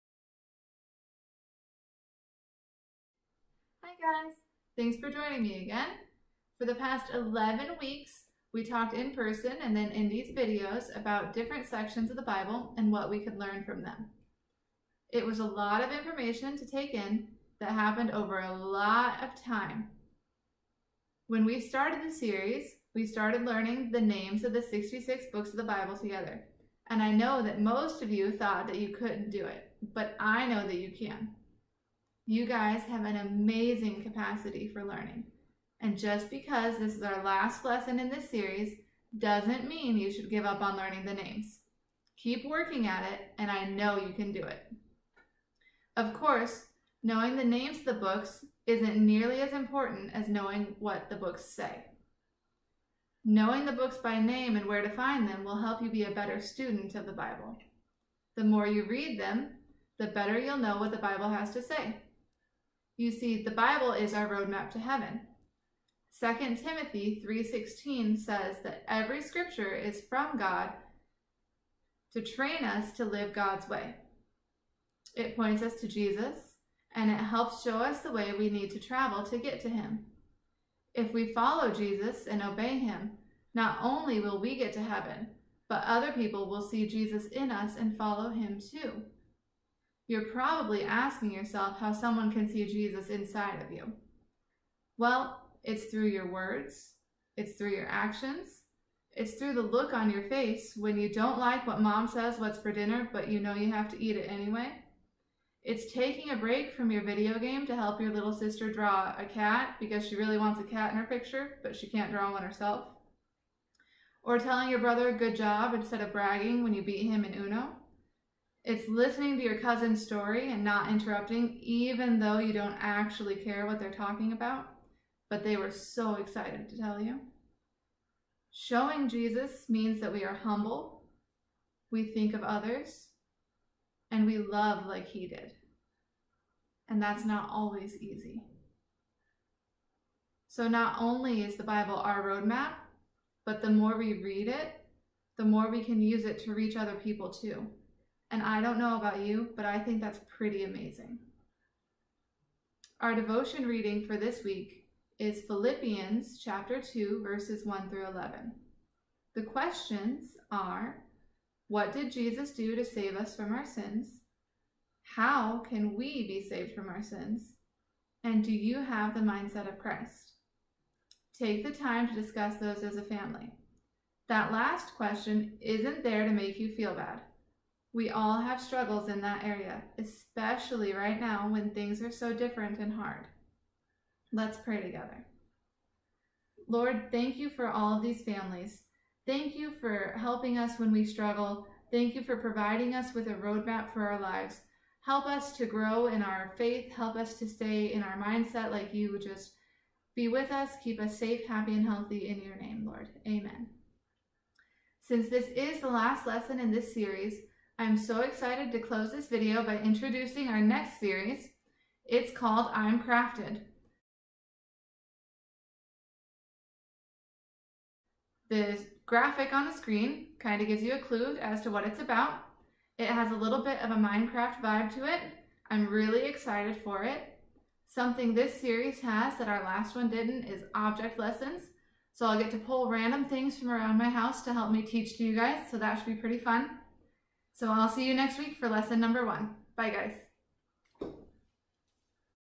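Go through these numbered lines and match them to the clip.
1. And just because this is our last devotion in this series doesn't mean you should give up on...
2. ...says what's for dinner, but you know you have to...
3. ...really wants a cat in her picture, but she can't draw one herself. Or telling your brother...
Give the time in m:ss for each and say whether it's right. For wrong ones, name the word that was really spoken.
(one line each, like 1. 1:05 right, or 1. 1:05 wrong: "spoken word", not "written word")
1. 0:35 wrong: "lesson", not "devotion"
2. 1:42 right
3. 1:50 right.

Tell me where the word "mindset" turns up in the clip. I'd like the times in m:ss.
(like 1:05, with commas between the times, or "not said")
2:49, 3:18.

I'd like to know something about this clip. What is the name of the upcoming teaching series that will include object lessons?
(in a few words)
I'm Crafted.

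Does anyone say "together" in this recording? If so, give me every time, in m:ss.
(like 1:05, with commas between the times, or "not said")
0:25, 3:04.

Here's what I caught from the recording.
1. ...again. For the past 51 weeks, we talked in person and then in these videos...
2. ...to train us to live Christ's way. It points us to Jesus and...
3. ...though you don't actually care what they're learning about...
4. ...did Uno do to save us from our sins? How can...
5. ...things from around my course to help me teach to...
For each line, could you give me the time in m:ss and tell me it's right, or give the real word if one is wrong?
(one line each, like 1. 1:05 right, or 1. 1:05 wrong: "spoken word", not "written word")
1. 0:05 wrong: "11", not "51"
2. 1:12 wrong: "God", not "Christ"
3. 2:02 wrong: "talking", not "learning"
4. 2:41 wrong: "Jesus", not "Uno"
5. 3:53 wrong: "house", not "course".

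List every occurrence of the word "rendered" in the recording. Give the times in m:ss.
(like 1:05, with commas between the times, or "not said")
not said.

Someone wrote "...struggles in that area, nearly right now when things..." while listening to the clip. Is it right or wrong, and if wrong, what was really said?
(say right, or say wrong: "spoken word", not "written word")
wrong: "especially", not "nearly".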